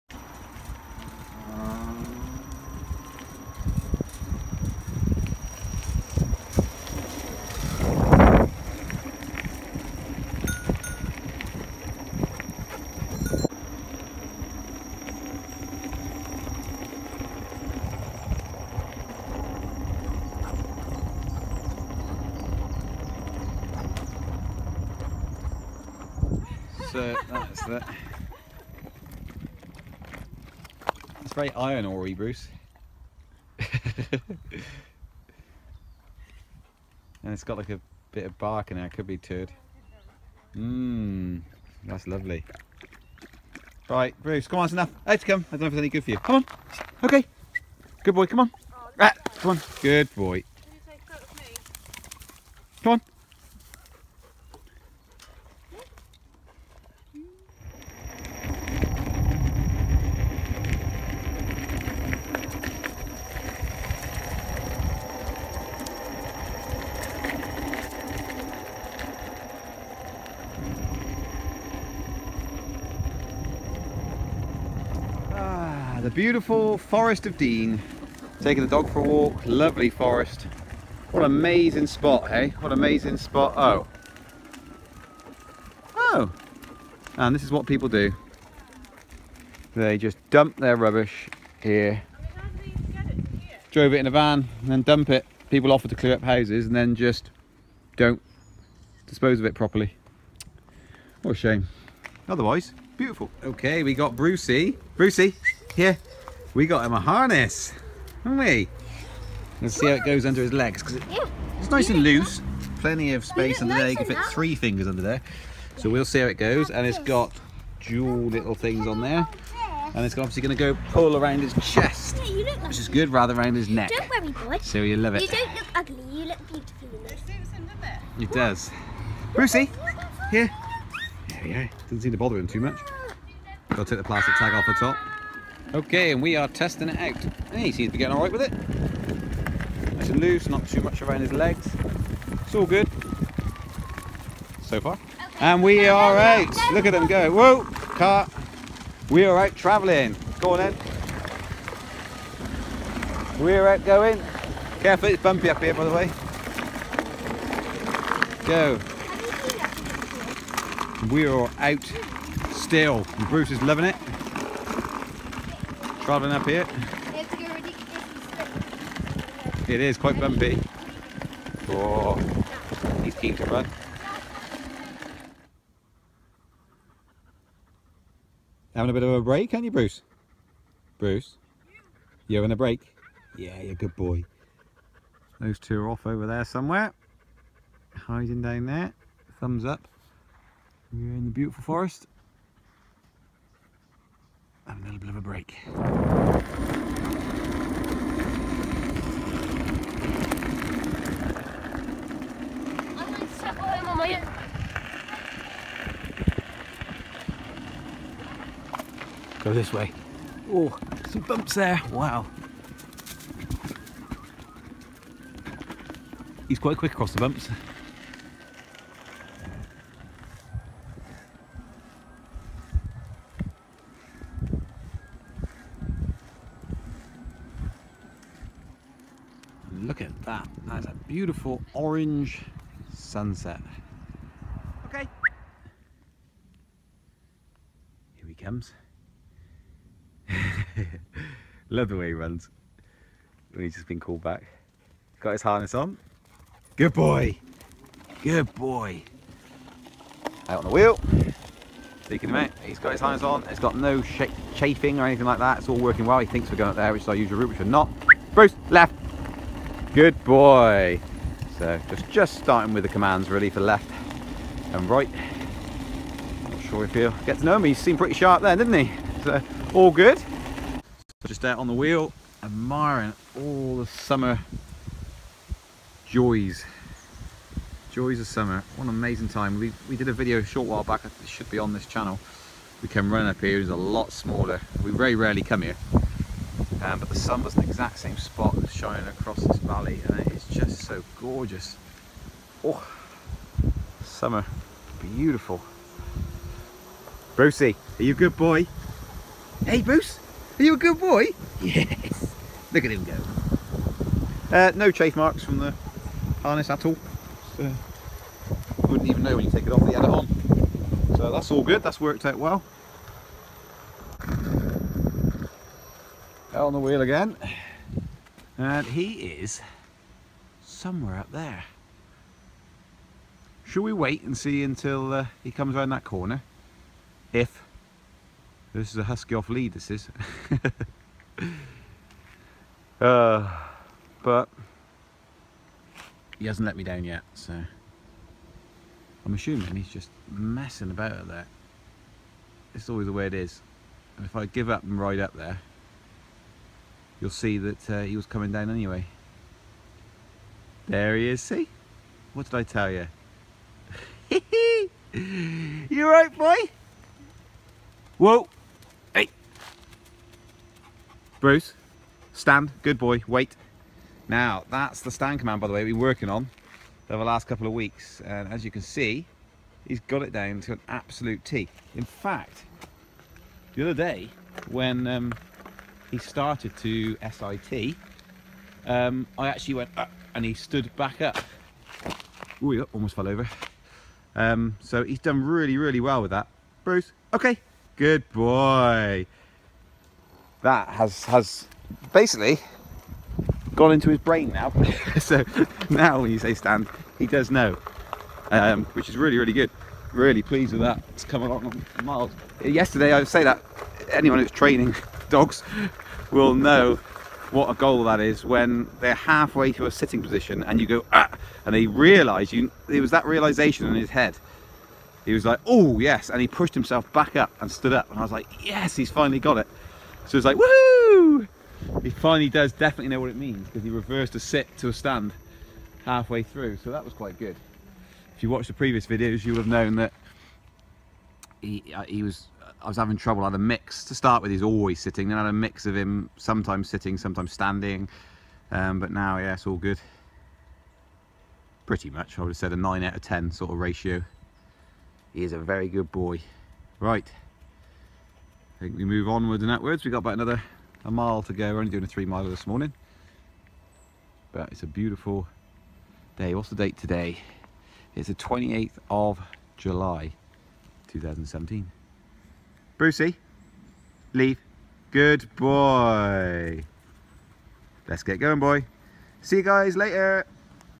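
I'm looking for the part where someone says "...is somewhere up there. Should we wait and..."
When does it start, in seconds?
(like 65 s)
319 s.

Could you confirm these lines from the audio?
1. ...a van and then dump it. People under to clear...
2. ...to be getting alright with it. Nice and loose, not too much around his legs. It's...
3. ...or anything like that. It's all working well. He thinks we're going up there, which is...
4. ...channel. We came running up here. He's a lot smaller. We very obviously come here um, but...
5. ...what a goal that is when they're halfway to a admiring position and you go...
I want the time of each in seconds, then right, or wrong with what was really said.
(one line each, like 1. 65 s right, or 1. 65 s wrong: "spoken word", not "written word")
1. 94 s wrong: "offer", not "under"
2. 137 s right
3. 254 s right
4. 281 s wrong: "rarely", not "obviously"
5. 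407 s wrong: "sitting", not "admiring".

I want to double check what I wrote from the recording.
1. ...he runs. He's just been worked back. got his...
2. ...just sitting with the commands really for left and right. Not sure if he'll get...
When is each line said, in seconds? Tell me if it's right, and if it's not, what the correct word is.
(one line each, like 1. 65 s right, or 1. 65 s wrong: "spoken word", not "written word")
1. 242 s wrong: "called", not "worked"
2. 262 s wrong: "starting", not "sitting".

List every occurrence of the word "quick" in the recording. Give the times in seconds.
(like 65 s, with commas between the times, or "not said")
216 s.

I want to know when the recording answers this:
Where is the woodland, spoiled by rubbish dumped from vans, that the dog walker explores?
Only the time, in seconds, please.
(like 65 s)
76 s.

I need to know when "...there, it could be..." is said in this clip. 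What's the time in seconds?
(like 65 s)
38 s.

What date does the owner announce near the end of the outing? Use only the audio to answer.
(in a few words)
28 July 2017.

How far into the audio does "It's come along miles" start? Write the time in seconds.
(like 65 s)
401 s.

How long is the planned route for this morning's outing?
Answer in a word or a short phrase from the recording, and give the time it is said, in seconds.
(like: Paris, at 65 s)
3 miles, at 452 s.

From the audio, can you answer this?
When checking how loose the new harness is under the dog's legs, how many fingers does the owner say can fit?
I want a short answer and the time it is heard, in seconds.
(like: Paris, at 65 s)
3, at 114 s.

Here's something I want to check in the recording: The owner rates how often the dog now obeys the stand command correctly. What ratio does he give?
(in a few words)
9 out of 10.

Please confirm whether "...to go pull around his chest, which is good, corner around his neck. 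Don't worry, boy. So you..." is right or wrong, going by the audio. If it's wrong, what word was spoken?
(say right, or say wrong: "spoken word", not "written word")
wrong: "rather", not "corner".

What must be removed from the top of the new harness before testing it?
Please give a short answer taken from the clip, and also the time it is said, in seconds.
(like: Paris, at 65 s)
plastic tag, at 134 s.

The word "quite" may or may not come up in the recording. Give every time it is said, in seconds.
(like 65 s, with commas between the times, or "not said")
169 s, 216 s, 427 s.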